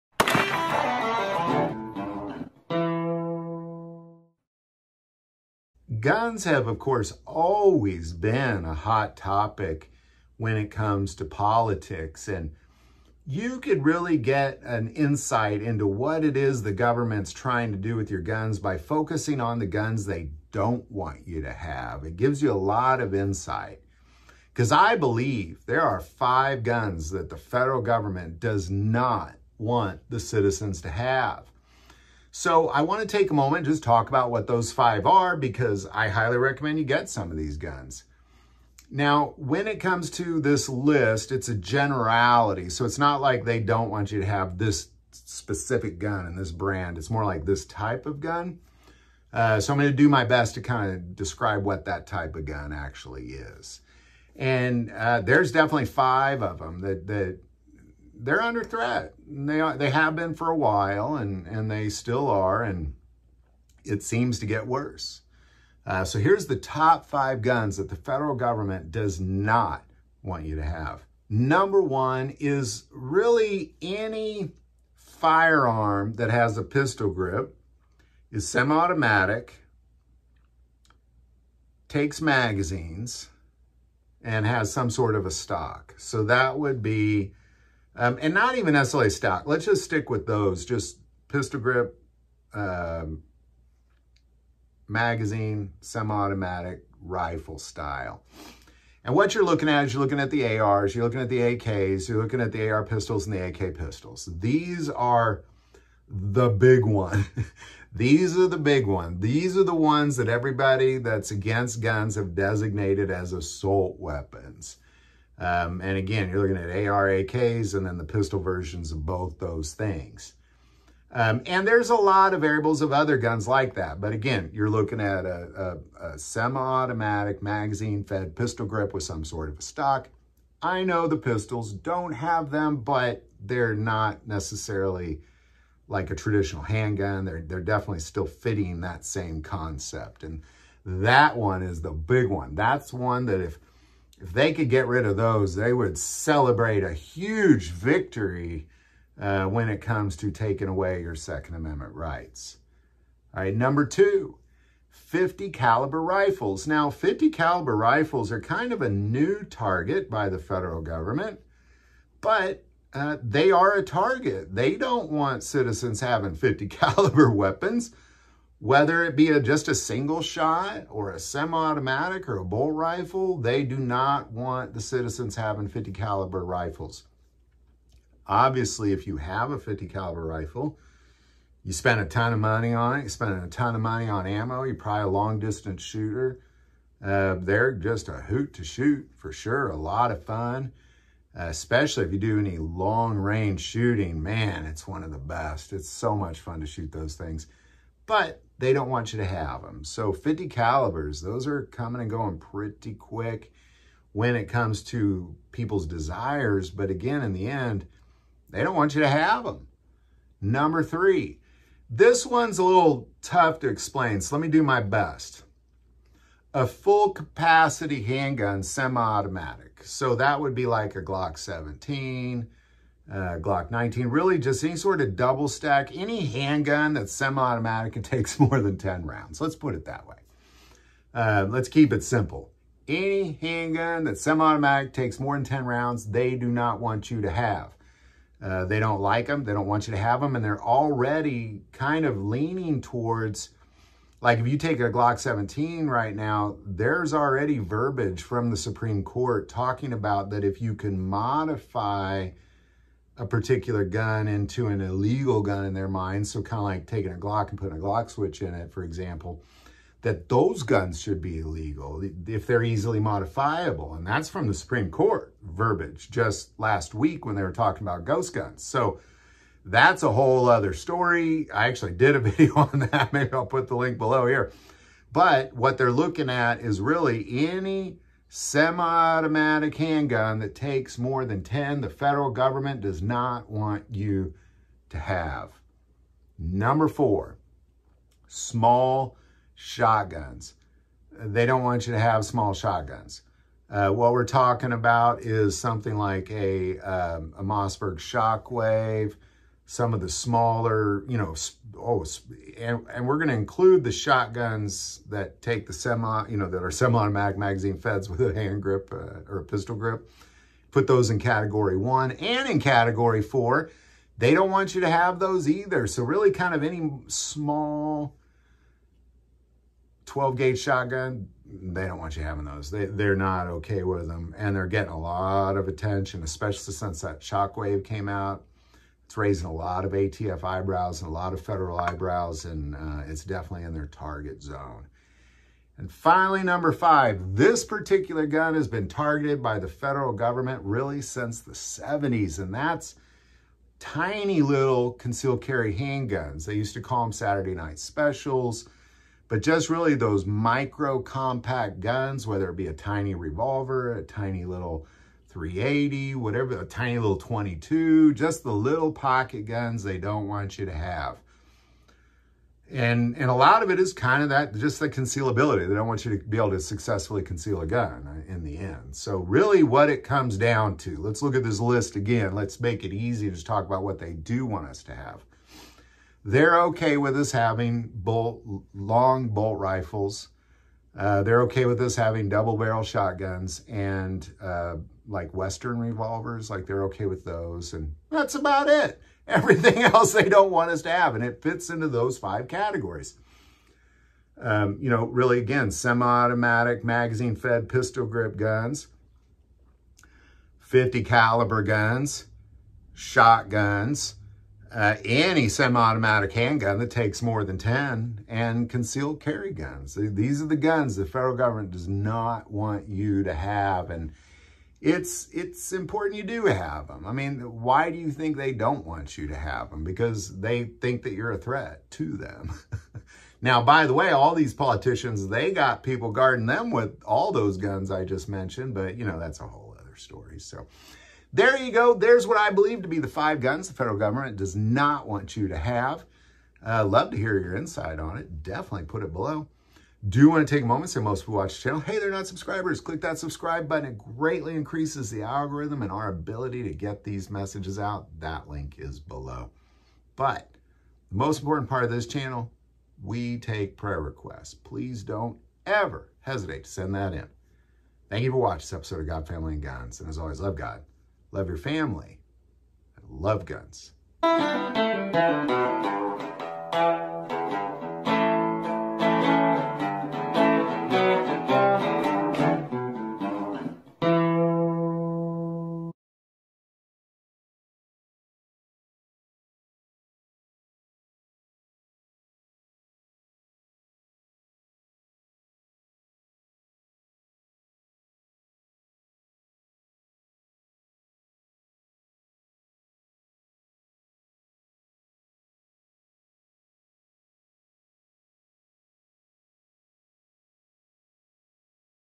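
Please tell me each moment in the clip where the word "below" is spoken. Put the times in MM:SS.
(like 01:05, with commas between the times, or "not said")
04:33, 07:19, 07:28.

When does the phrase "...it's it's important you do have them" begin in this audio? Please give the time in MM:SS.
06:54.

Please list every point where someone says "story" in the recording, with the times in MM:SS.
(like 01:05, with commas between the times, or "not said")
04:30, 07:09.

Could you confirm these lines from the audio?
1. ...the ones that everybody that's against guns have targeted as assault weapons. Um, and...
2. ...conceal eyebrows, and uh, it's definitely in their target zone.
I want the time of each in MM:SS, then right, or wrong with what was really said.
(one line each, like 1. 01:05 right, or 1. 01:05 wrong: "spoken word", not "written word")
1. 01:49 wrong: "designated", not "targeted"
2. 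05:31 wrong: "federal", not "conceal".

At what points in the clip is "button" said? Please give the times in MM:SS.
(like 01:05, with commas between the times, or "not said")
07:23.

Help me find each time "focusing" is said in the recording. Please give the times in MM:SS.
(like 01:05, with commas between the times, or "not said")
00:18.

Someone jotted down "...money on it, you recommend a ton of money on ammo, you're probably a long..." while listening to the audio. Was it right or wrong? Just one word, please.
wrong.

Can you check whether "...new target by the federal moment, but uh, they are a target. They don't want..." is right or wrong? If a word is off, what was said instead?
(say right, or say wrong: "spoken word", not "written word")
wrong: "government", not "moment".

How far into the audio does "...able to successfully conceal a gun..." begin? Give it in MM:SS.
06:06.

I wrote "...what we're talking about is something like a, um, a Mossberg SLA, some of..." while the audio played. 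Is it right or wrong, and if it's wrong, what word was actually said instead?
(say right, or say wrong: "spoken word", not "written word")
wrong: "Shockwave", not "SLA".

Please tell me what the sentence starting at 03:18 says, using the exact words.
But they don't want you to have them.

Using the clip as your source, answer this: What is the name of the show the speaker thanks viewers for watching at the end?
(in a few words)
God, Family, and Guns.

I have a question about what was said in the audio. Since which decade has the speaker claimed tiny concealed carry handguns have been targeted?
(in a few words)
the 70s.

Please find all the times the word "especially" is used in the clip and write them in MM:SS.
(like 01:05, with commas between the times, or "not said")
03:11, 05:26.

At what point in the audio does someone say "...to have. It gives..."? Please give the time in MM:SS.
00:21.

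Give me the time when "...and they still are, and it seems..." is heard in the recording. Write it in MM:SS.
01:01.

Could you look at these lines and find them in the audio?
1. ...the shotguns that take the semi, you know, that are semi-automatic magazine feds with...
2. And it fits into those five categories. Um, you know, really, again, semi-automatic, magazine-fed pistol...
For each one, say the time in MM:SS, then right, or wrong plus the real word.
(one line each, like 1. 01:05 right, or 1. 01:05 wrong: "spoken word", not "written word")
1. 05:03 right
2. 06:31 right.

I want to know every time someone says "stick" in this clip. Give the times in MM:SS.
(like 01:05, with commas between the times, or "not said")
01:29.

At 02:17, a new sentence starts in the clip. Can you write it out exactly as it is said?
They're, they're definitely still fitting that same concept.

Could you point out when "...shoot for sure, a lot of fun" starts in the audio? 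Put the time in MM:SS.
03:08.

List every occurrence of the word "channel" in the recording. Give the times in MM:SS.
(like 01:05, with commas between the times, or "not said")
07:21, 07:32.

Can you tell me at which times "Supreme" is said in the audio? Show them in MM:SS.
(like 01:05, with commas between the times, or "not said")
04:08, 04:24.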